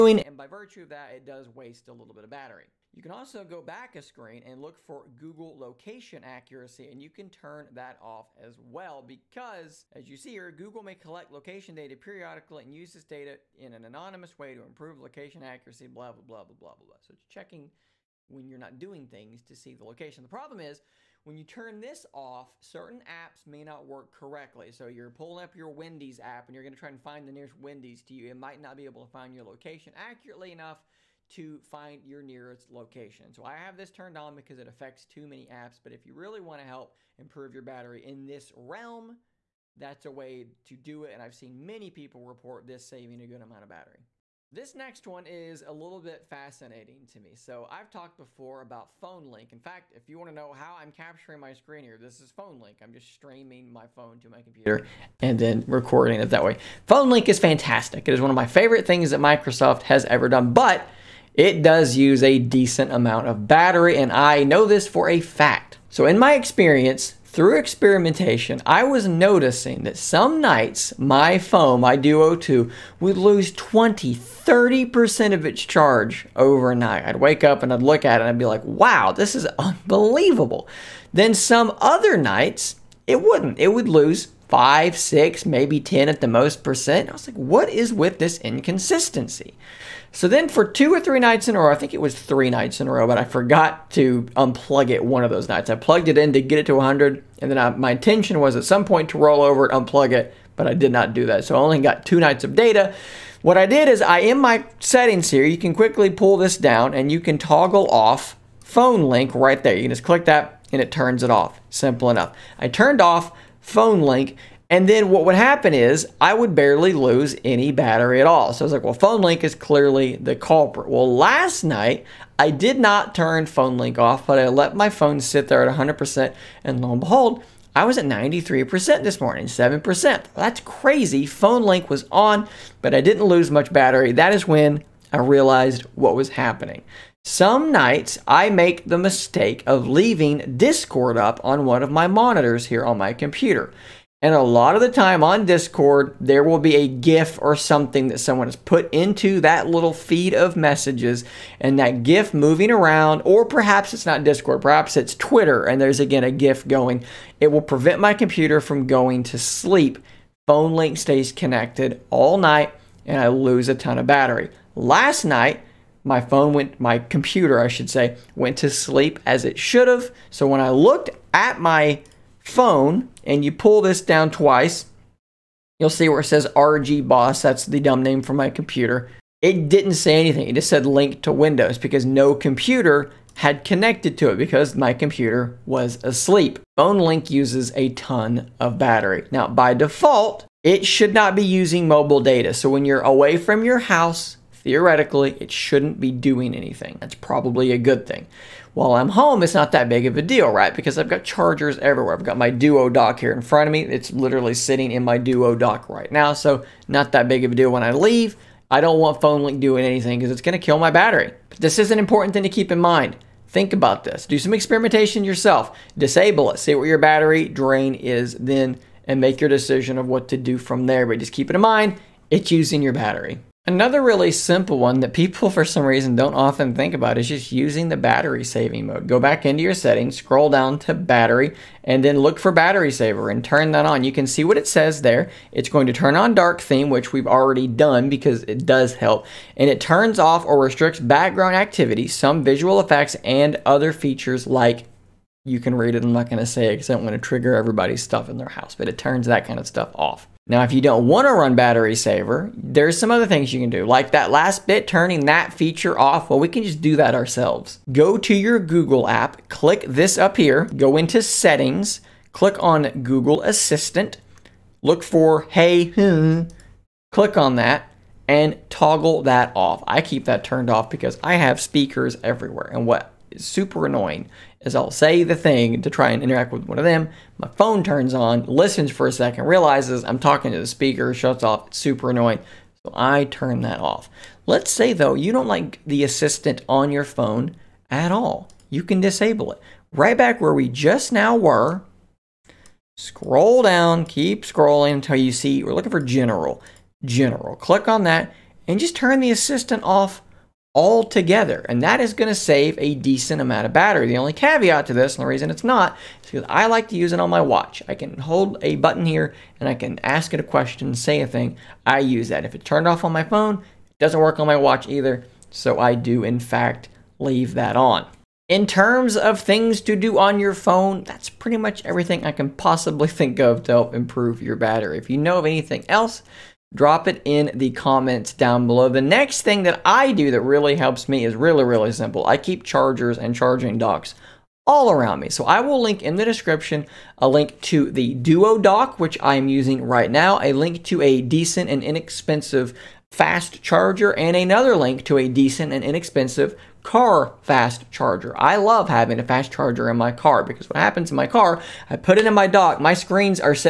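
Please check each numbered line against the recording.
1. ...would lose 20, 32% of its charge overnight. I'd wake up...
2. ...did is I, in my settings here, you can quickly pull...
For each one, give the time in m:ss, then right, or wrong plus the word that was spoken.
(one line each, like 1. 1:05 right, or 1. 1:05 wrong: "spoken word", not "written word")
1. 1:12 wrong: "30", not "32"
2. 1:43 right.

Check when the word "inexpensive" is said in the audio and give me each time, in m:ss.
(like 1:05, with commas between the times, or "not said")
5:41, 5:45.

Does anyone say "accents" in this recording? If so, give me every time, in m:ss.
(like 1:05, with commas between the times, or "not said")
not said.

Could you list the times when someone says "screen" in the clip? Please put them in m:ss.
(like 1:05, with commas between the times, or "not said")
0:04, 0:51, 5:52.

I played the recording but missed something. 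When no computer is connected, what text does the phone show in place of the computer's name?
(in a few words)
Link to Windows.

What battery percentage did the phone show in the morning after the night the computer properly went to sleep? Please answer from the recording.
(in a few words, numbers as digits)
93%.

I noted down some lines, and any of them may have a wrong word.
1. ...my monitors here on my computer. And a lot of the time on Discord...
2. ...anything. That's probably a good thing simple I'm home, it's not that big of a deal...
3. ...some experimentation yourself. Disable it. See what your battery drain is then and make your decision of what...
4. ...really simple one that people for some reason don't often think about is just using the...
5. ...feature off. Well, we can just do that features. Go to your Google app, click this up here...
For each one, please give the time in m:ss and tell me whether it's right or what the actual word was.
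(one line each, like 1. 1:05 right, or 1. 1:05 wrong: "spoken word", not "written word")
1. 2:21 right
2. 3:16 wrong: "while", not "simple"
3. 3:34 right
4. 3:44 right
5. 4:15 wrong: "ourselves", not "features".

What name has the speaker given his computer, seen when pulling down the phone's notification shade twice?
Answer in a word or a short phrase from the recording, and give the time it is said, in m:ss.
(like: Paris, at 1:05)
RG Boss, at 2:56.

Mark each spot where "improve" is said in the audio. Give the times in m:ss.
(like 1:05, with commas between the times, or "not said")
0:14, 0:37, 5:23.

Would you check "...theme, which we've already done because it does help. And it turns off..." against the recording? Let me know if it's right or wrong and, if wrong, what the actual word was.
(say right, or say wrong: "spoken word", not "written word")
right.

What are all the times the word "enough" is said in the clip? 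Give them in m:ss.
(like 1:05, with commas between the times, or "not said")
0:30, 1:52.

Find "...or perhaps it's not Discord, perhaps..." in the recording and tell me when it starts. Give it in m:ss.
2:33.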